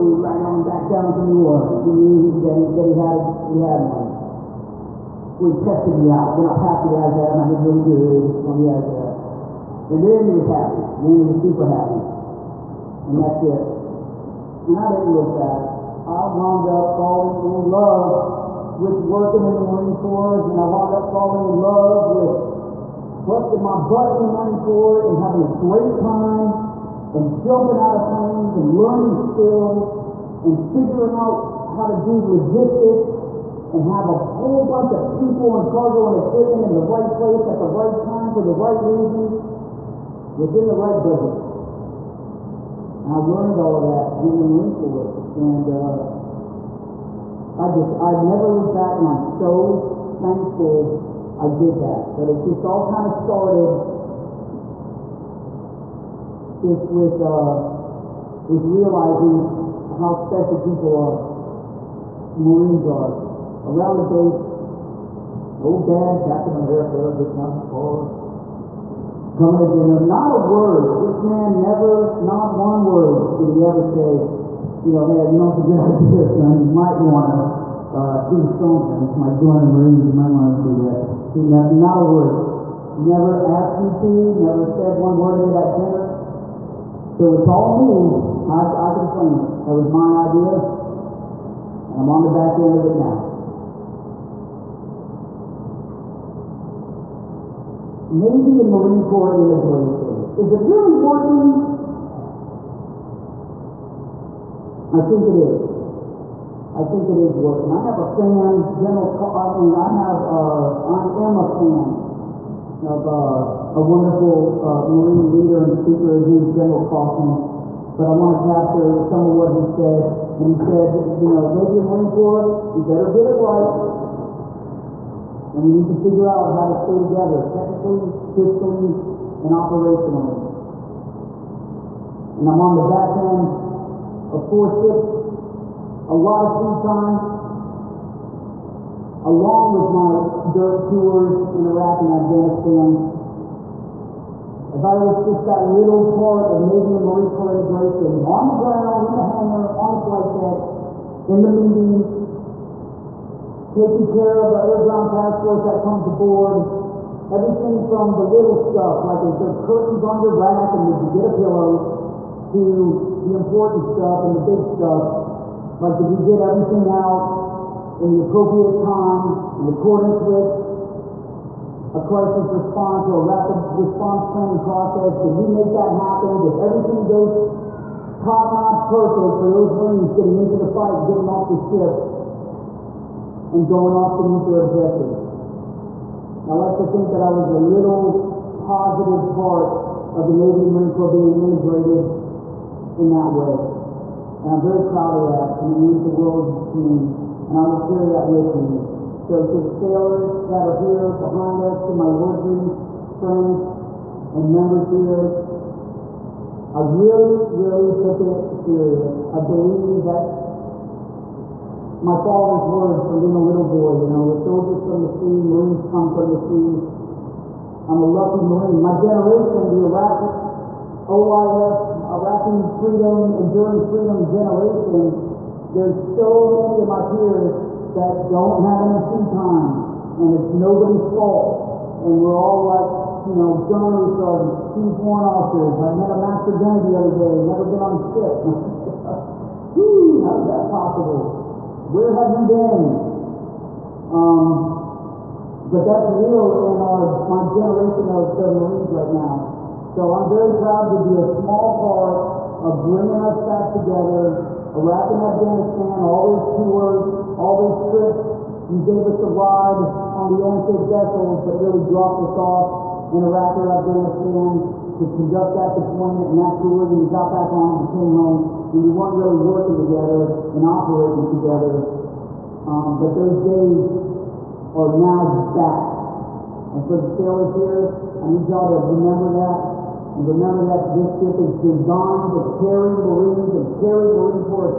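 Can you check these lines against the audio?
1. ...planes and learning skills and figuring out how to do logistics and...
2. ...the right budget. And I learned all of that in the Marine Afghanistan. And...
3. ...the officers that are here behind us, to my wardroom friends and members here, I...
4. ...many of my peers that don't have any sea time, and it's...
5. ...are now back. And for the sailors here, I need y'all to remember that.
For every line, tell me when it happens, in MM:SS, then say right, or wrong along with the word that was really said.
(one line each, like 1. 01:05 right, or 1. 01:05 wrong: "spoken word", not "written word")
1. 00:28 right
2. 00:40 wrong: "Corps", not "Afghanistan"
3. 03:19 wrong: "sailors", not "officers"
4. 03:46 right
5. 04:34 right.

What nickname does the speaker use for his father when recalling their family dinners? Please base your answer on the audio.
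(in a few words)
Captain America.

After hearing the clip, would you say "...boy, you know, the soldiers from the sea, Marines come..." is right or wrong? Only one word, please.
right.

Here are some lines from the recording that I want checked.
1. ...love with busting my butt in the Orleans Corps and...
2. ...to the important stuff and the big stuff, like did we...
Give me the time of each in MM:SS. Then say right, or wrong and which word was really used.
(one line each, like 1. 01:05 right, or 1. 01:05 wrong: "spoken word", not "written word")
1. 00:21 wrong: "Marine", not "Orleans"
2. 02:42 right.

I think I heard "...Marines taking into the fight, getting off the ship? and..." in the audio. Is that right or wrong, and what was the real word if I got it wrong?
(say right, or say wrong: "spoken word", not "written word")
wrong: "getting", not "taking".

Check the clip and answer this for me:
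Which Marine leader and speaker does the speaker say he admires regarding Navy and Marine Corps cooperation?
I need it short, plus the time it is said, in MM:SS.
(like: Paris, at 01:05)
General Kaufman, at 01:56.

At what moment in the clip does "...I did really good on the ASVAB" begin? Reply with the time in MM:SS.
00:07.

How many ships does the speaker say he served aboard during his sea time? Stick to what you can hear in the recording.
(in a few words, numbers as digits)
4.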